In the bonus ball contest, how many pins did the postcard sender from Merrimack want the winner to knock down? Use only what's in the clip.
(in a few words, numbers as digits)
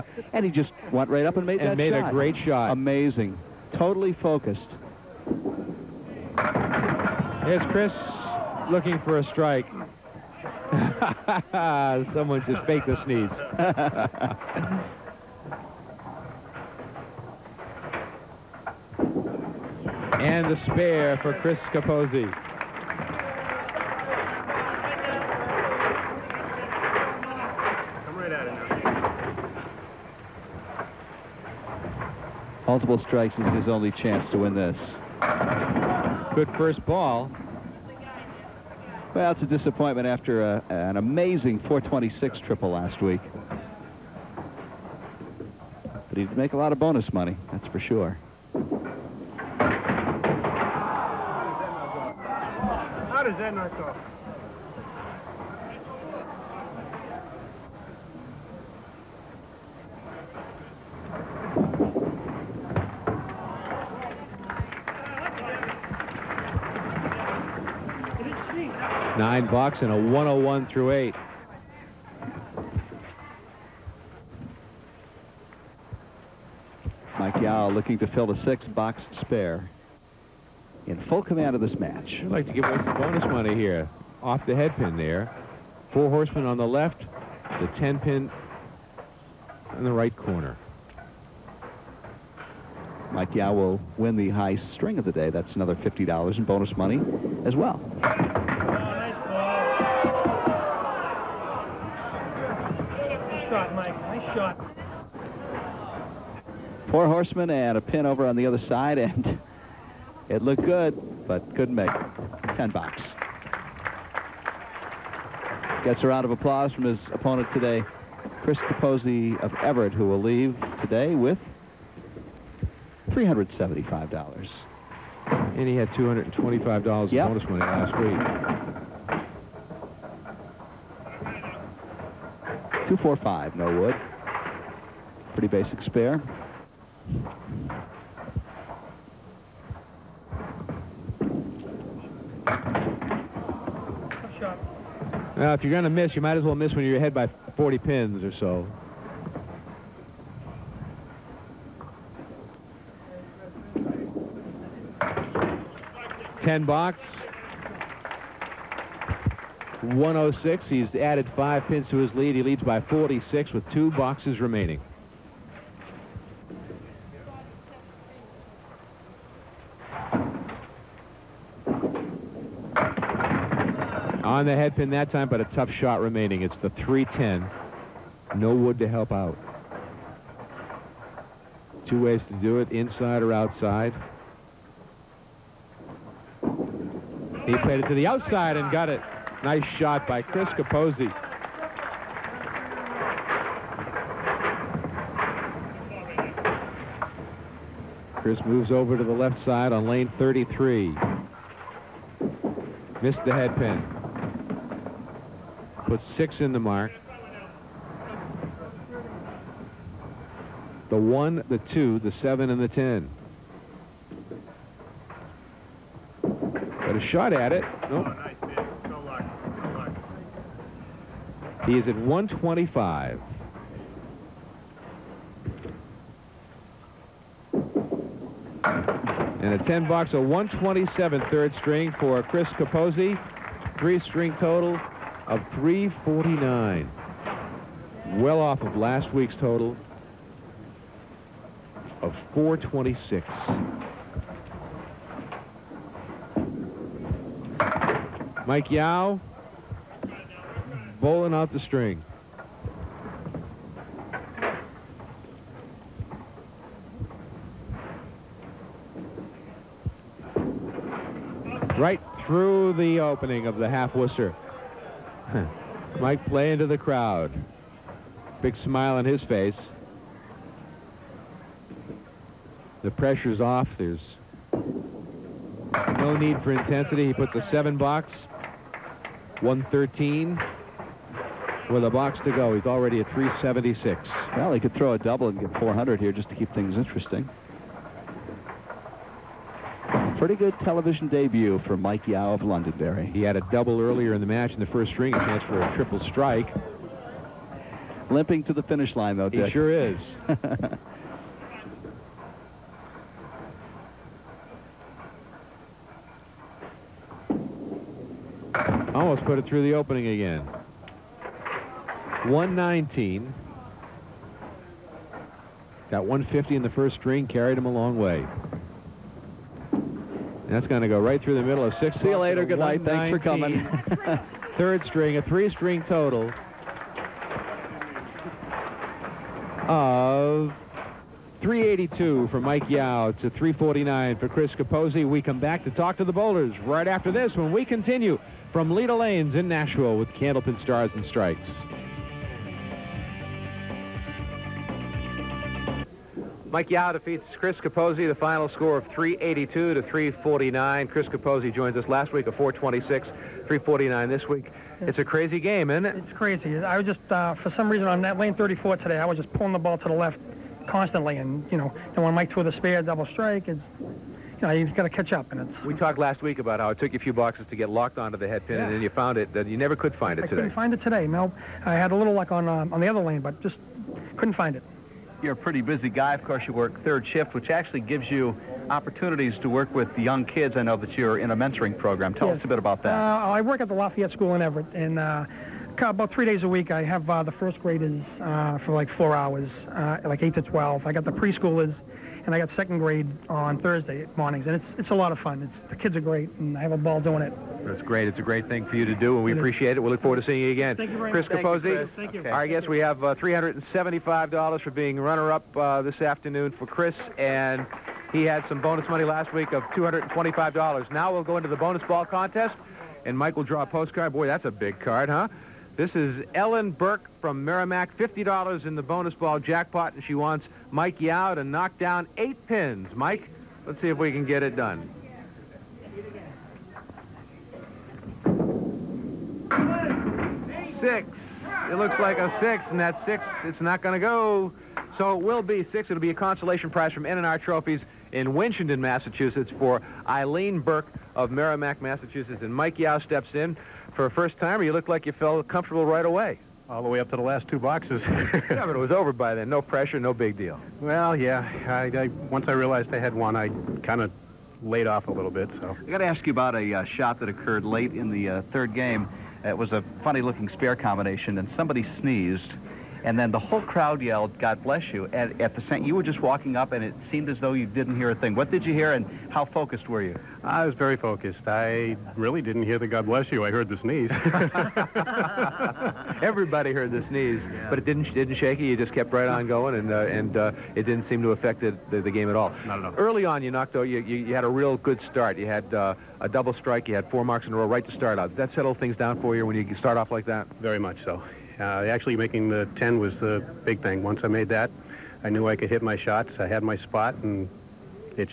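8.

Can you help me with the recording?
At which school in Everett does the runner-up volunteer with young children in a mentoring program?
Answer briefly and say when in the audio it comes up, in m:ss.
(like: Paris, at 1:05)
Lafayette School, at 6:23.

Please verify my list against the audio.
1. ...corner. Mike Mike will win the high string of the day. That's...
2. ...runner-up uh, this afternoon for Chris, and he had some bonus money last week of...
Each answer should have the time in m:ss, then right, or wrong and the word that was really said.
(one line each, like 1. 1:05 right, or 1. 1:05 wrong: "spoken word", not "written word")
1. 1:30 wrong: "Yow", not "Mike"
2. 6:44 right.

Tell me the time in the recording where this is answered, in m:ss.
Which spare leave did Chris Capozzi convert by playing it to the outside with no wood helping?
2:56.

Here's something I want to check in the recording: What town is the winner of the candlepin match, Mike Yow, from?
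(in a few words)
Londonderry.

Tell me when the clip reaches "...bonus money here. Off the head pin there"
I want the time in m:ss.
1:22.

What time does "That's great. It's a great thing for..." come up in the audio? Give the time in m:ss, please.
6:37.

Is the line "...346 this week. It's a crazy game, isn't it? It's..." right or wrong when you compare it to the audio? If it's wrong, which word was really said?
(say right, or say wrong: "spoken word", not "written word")
wrong: "349", not "346".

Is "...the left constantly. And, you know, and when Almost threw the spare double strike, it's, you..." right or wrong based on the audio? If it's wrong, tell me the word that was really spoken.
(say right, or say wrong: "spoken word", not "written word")
wrong: "Mike", not "Almost".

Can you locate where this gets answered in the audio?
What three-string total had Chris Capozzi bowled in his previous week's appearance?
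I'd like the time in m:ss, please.
0:41.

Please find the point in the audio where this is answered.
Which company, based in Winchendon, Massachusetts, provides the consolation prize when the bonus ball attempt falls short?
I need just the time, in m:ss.
7:17.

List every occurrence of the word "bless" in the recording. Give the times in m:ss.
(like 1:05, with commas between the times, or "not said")
7:44, 7:53.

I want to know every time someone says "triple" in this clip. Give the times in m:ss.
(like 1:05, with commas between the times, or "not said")
0:42, 4:55.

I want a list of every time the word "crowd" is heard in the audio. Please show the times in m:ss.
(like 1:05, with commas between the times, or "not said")
4:26, 7:43.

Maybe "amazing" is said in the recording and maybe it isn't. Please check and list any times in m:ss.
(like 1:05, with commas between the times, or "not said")
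0:02, 0:40.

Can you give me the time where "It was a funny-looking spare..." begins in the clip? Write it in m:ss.
7:39.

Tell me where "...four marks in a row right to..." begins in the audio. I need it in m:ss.
8:07.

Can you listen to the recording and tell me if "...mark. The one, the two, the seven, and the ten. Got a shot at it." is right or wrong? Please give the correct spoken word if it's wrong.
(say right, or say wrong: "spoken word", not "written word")
right.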